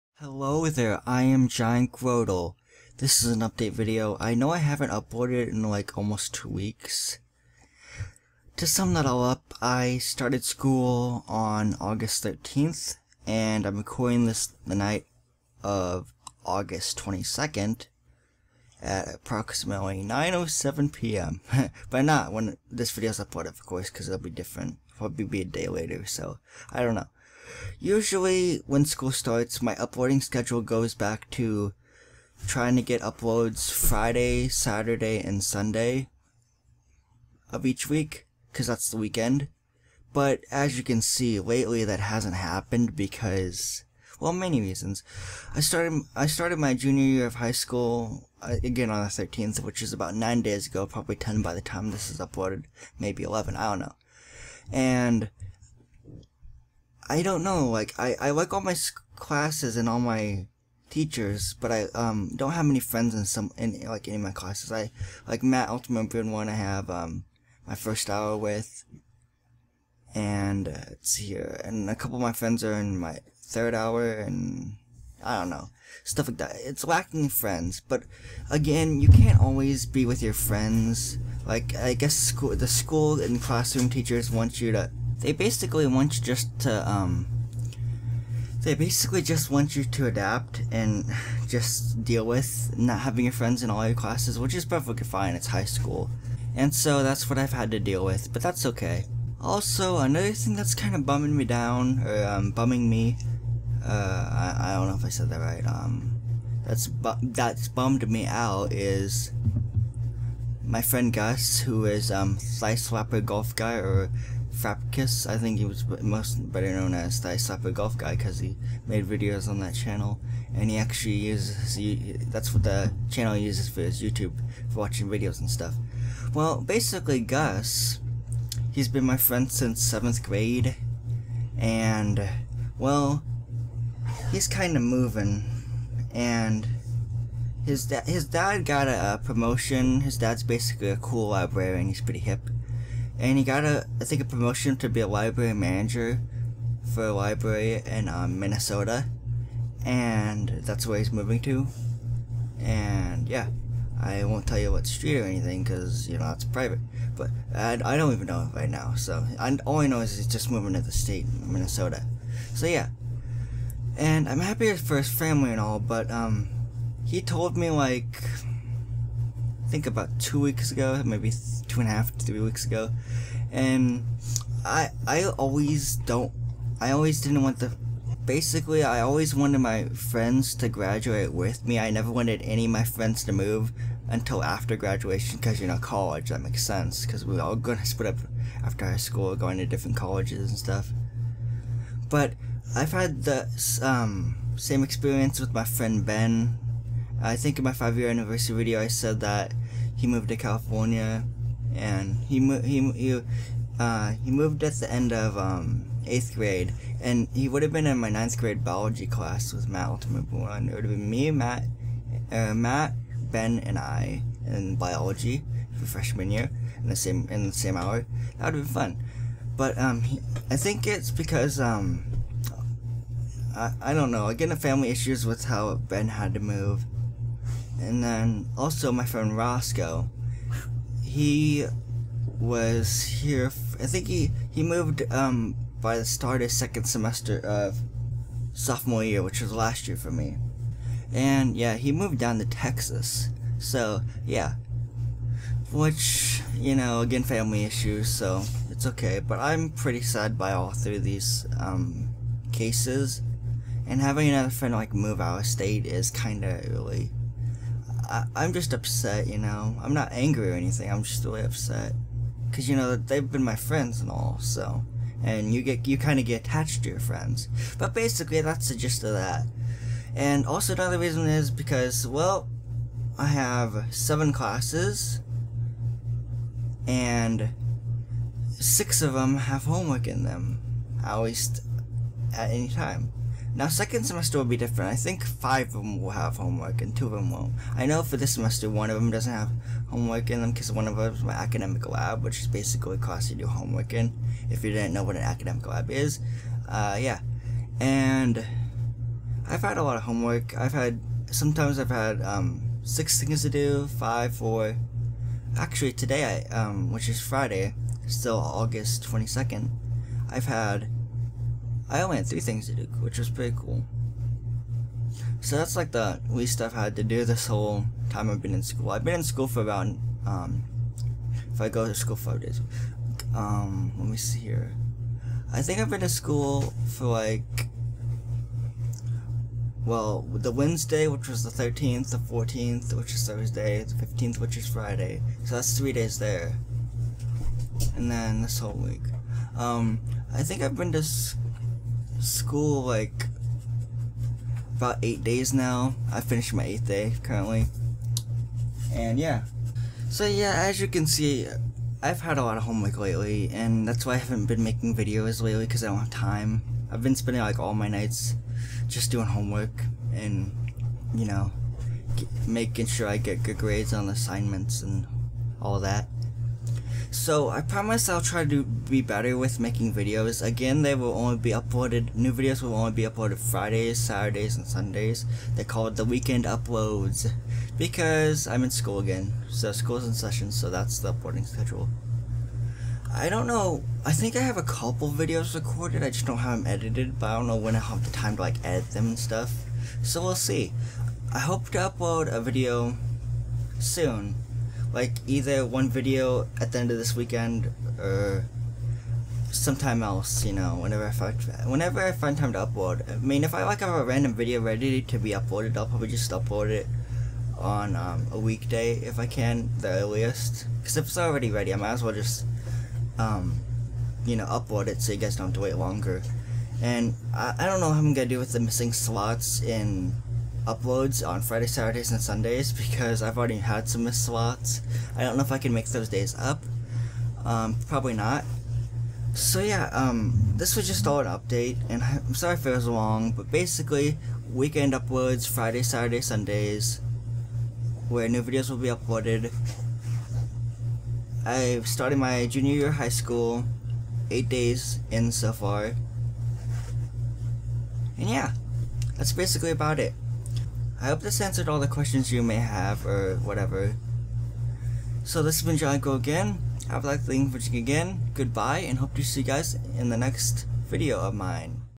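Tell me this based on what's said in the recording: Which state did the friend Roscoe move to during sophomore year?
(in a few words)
Texas.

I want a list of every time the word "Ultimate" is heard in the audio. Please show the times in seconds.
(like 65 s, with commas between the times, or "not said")
65 s, 209 s.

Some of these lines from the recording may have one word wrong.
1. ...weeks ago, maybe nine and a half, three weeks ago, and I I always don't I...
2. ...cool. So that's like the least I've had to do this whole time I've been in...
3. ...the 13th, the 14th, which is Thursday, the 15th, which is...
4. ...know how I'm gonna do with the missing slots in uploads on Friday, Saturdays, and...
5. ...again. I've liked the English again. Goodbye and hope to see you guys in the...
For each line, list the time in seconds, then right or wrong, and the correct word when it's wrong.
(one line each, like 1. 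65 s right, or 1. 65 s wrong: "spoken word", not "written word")
1. 170 s wrong: "two", not "nine"
2. 313 s right
3. 331 s right
4. 417 s right
5. 455 s right.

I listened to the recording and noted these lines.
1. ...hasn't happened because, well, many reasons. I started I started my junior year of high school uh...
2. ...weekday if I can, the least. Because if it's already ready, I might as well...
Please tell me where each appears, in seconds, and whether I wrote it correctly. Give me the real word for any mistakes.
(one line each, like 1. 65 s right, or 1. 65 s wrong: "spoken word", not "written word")
1. 41 s right
2. 408 s wrong: "earliest", not "least".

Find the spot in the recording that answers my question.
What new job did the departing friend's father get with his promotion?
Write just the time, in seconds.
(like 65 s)
145 s.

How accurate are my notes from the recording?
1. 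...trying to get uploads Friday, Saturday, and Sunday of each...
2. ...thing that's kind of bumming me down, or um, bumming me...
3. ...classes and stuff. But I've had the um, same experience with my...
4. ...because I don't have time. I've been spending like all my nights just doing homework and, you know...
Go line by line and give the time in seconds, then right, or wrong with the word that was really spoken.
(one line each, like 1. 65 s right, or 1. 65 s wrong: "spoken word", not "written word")
1. 32 s right
2. 100 s right
3. 189 s wrong: "colleges", not "classes"
4. 355 s right.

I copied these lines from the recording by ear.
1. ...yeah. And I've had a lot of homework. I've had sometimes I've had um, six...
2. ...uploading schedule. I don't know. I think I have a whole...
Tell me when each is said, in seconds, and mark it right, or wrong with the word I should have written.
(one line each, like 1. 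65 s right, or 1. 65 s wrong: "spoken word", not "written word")
1. 296 s right
2. 381 s wrong: "couple", not "whole".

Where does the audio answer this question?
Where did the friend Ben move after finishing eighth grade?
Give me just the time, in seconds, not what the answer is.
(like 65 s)
200 s.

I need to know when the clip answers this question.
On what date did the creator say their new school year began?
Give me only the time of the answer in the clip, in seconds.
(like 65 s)
11 s.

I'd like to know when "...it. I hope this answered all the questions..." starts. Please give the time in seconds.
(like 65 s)
449 s.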